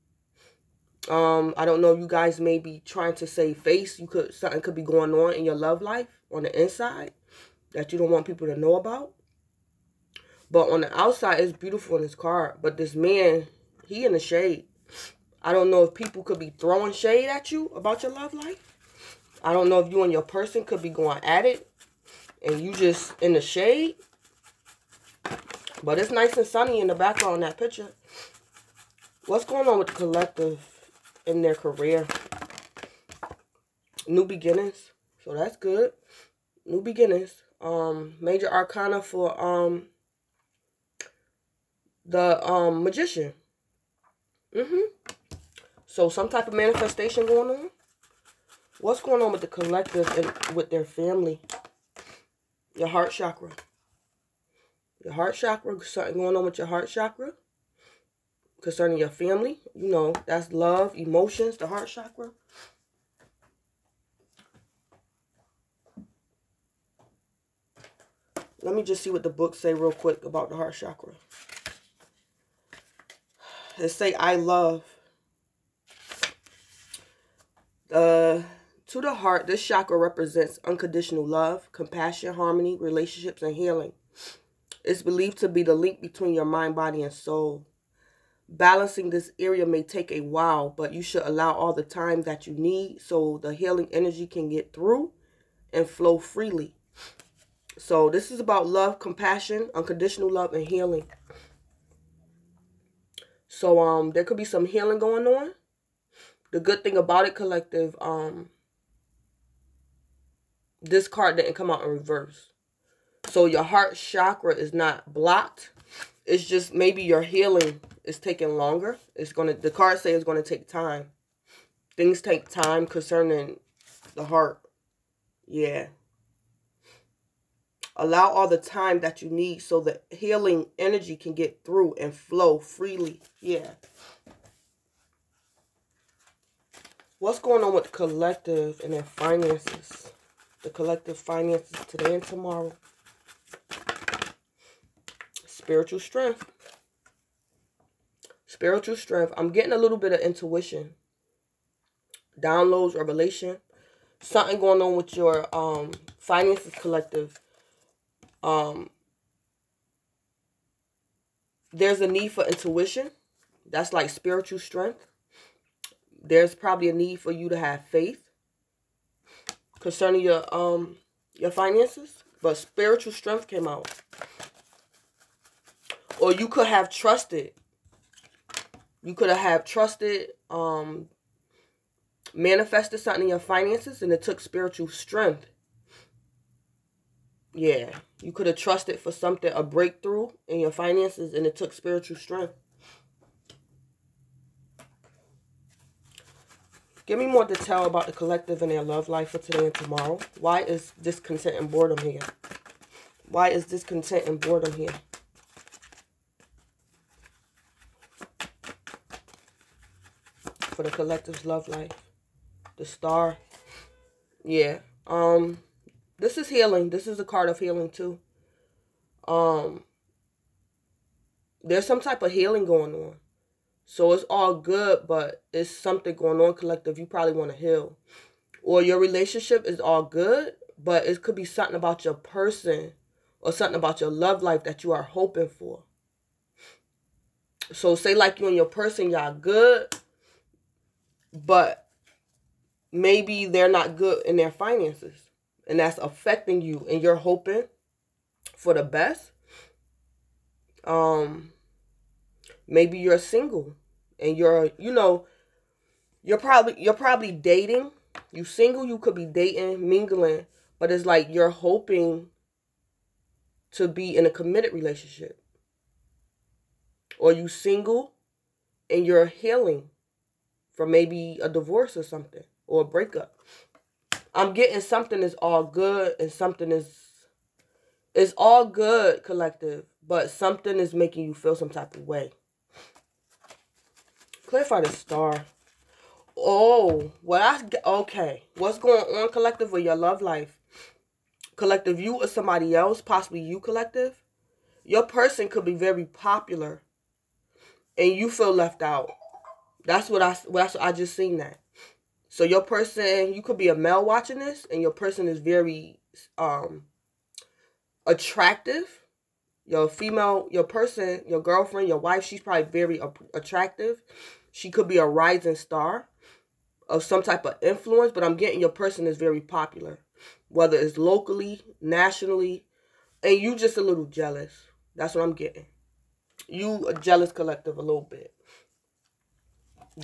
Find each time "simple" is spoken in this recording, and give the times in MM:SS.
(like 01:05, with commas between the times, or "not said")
not said.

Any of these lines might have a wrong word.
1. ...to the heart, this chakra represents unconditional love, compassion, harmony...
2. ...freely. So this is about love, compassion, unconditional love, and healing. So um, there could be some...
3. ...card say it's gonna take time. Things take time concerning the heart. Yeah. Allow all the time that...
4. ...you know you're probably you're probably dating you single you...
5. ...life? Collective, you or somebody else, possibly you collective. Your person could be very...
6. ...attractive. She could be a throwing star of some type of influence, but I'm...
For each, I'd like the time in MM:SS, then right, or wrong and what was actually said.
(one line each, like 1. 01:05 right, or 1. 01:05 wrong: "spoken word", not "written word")
1. 01:18 right
2. 01:36 right
3. 01:59 right
4. 04:14 right
5. 04:50 right
6. 05:13 wrong: "rising", not "throwing".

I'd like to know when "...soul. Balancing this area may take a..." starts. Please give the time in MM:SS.
01:27.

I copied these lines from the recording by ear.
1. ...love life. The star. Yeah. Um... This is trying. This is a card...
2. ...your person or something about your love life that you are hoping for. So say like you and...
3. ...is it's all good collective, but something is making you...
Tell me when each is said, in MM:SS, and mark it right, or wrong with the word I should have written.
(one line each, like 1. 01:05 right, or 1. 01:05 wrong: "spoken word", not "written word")
1. 03:31 wrong: "healing", not "trying"
2. 03:52 right
3. 04:36 right.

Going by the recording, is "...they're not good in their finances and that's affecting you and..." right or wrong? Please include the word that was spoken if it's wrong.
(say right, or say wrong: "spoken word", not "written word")
right.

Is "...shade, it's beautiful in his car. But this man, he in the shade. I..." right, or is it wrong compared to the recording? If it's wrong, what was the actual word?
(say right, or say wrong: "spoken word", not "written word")
wrong: "outside", not "shade".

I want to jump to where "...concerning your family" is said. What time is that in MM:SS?
00:58.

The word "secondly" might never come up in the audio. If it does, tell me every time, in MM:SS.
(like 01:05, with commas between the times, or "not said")
not said.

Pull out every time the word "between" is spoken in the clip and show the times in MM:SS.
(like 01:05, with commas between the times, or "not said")
01:26.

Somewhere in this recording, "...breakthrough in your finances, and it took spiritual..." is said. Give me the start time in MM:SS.
03:09.